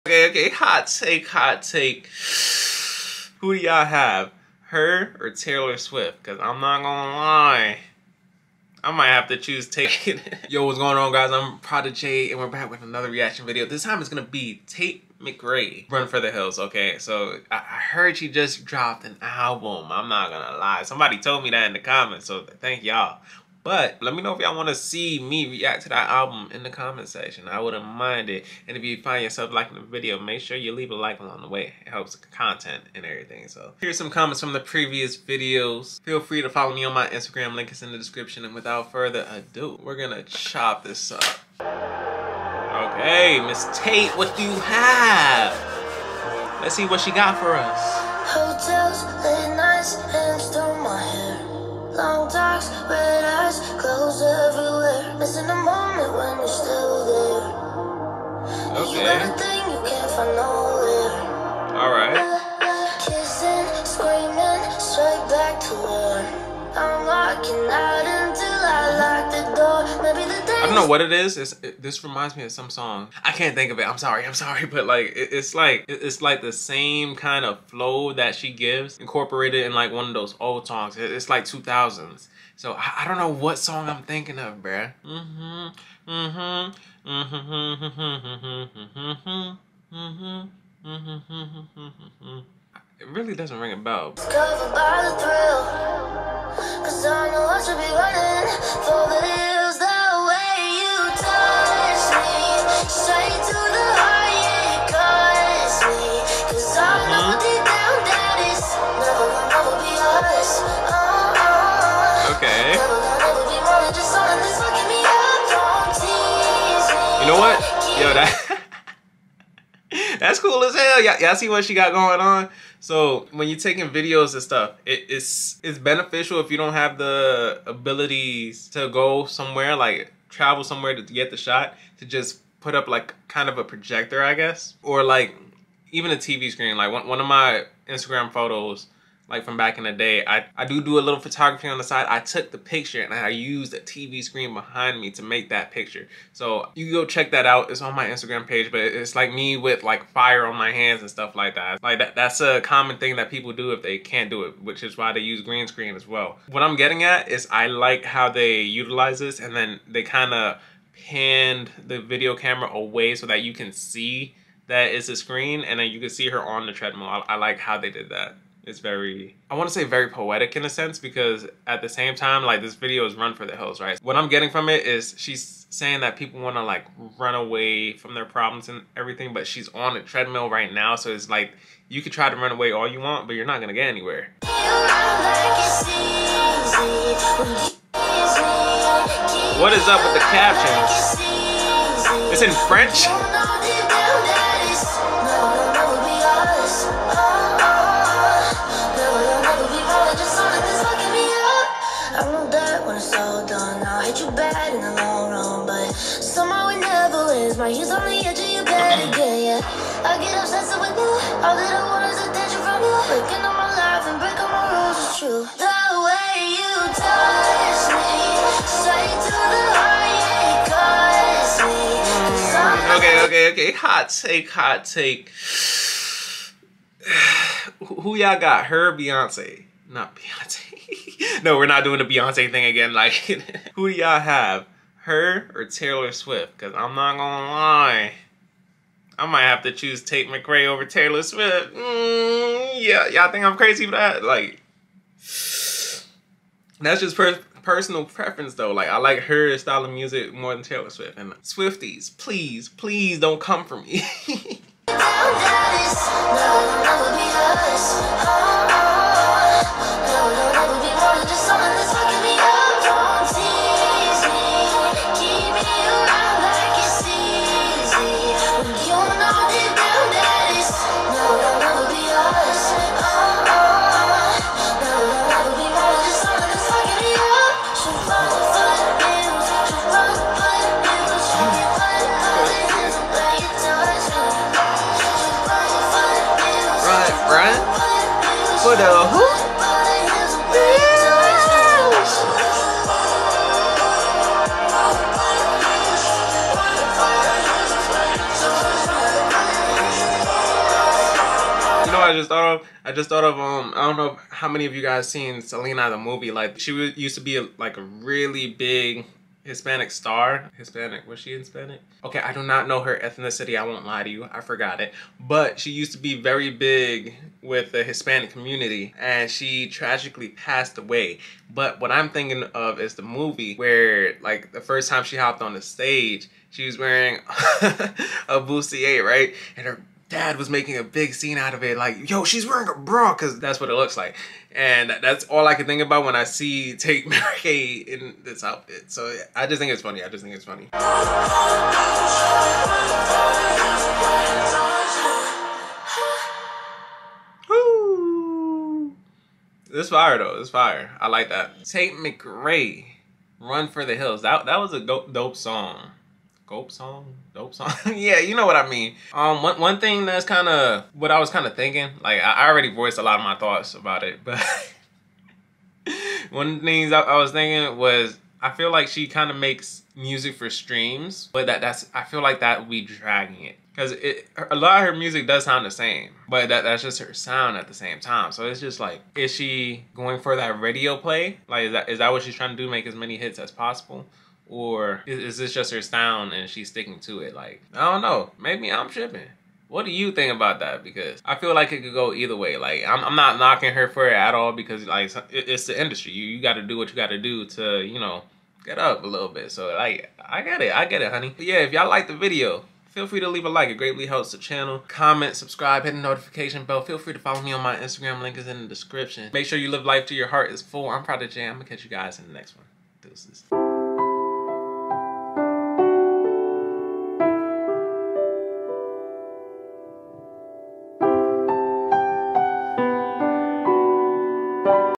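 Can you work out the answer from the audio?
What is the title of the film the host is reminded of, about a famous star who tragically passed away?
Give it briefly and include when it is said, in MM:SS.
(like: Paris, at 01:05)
Selena, at 05:05.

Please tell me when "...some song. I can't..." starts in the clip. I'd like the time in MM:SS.
01:12.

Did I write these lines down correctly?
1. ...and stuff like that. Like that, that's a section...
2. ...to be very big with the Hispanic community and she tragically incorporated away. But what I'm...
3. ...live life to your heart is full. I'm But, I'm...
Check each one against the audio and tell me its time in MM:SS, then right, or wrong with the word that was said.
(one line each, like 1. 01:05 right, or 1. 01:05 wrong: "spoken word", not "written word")
1. 02:31 wrong: "common", not "section"
2. 05:15 wrong: "passed", not "incorporated"
3. 06:49 wrong: "Prodijet", not "But".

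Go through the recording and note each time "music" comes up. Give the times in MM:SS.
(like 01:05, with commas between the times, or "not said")
04:09, 06:09, 06:14.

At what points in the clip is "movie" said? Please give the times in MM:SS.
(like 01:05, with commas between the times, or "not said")
05:05, 05:23.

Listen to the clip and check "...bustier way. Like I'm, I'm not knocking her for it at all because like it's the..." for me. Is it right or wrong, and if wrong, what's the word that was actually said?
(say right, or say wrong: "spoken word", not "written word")
wrong: "either", not "bustier".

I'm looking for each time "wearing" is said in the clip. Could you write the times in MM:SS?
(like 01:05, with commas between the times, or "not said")
05:26, 05:32.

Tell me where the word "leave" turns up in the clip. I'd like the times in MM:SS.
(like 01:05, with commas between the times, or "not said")
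00:30, 06:43.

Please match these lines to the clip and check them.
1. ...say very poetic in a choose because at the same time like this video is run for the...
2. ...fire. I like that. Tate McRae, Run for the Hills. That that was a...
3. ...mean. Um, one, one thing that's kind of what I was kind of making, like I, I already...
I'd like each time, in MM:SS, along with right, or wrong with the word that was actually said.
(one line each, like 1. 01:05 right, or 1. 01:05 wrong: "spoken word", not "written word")
1. 02:49 wrong: "sense", not "choose"
2. 05:50 right
3. 05:58 wrong: "thinking", not "making".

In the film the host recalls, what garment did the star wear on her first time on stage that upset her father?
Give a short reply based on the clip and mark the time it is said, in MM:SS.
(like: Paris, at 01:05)
Bustier, at 05:28.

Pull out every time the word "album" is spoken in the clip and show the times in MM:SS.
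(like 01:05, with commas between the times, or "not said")
00:19, 00:26.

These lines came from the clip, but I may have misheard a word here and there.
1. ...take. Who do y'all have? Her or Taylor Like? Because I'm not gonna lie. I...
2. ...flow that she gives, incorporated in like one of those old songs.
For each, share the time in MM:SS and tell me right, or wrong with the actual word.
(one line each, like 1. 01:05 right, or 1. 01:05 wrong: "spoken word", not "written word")
1. 00:01 wrong: "Swift", not "Like"
2. 01:17 right.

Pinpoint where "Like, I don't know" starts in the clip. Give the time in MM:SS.
06:27.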